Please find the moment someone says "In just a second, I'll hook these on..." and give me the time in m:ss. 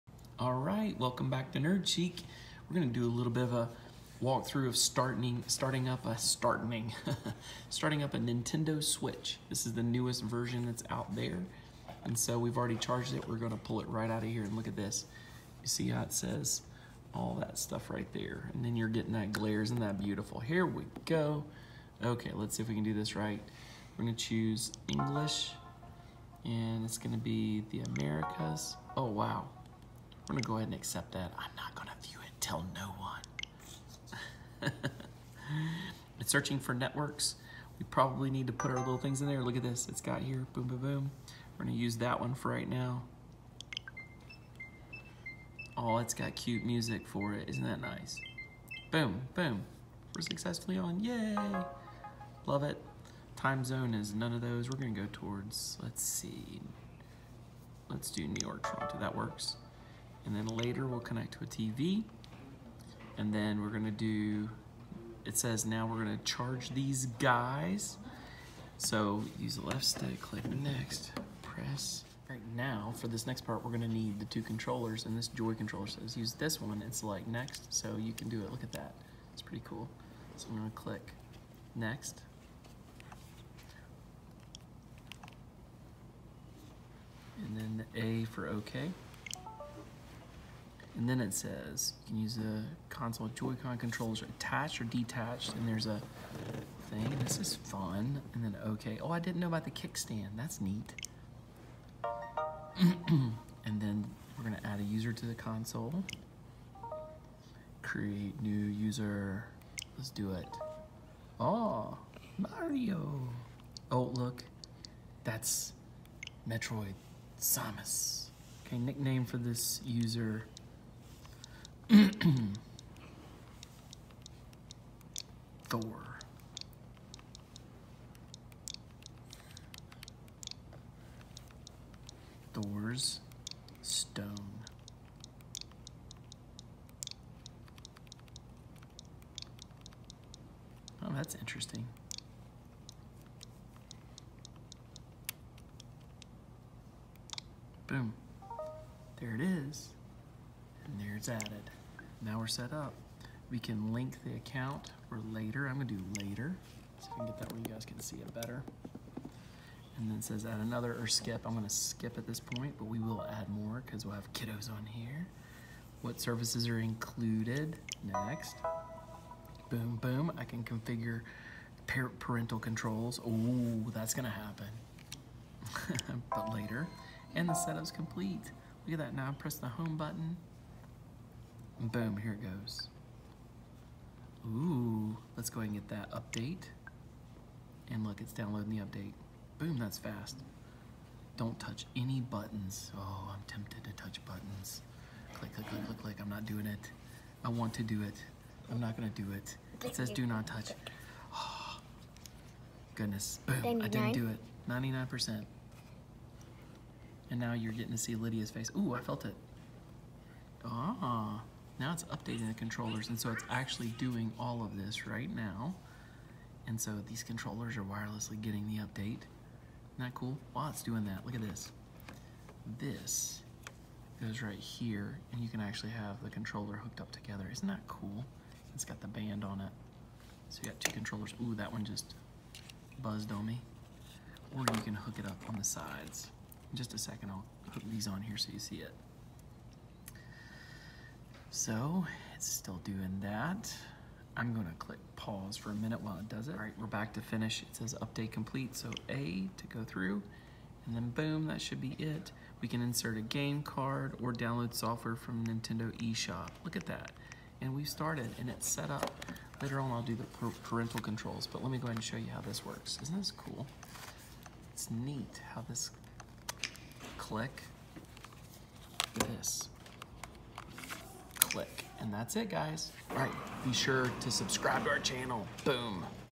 3:56.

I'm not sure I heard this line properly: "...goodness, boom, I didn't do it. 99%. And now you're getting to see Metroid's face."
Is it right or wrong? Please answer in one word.
wrong.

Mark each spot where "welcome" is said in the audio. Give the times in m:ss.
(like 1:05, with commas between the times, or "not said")
0:00.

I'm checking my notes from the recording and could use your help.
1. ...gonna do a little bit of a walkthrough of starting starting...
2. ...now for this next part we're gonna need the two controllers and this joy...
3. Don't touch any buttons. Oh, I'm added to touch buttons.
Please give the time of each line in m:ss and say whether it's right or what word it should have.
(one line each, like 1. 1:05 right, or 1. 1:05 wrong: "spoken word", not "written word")
1. 0:02 right
2. 1:12 right
3. 3:11 wrong: "tempted", not "added".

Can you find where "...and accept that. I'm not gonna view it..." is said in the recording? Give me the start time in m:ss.
0:30.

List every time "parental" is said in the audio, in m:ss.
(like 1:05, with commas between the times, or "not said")
2:52, 4:20.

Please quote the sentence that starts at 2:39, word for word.
And then says add another or skip.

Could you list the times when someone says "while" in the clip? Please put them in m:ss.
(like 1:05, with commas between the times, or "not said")
3:40, 4:06.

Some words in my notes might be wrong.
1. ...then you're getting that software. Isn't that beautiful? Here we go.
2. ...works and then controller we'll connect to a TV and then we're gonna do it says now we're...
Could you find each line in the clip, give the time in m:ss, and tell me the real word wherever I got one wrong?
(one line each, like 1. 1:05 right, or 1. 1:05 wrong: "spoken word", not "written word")
1. 0:18 wrong: "glare", not "software"
2. 0:59 wrong: "later", not "controller".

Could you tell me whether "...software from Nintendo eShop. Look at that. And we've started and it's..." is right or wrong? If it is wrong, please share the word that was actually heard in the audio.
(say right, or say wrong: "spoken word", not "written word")
right.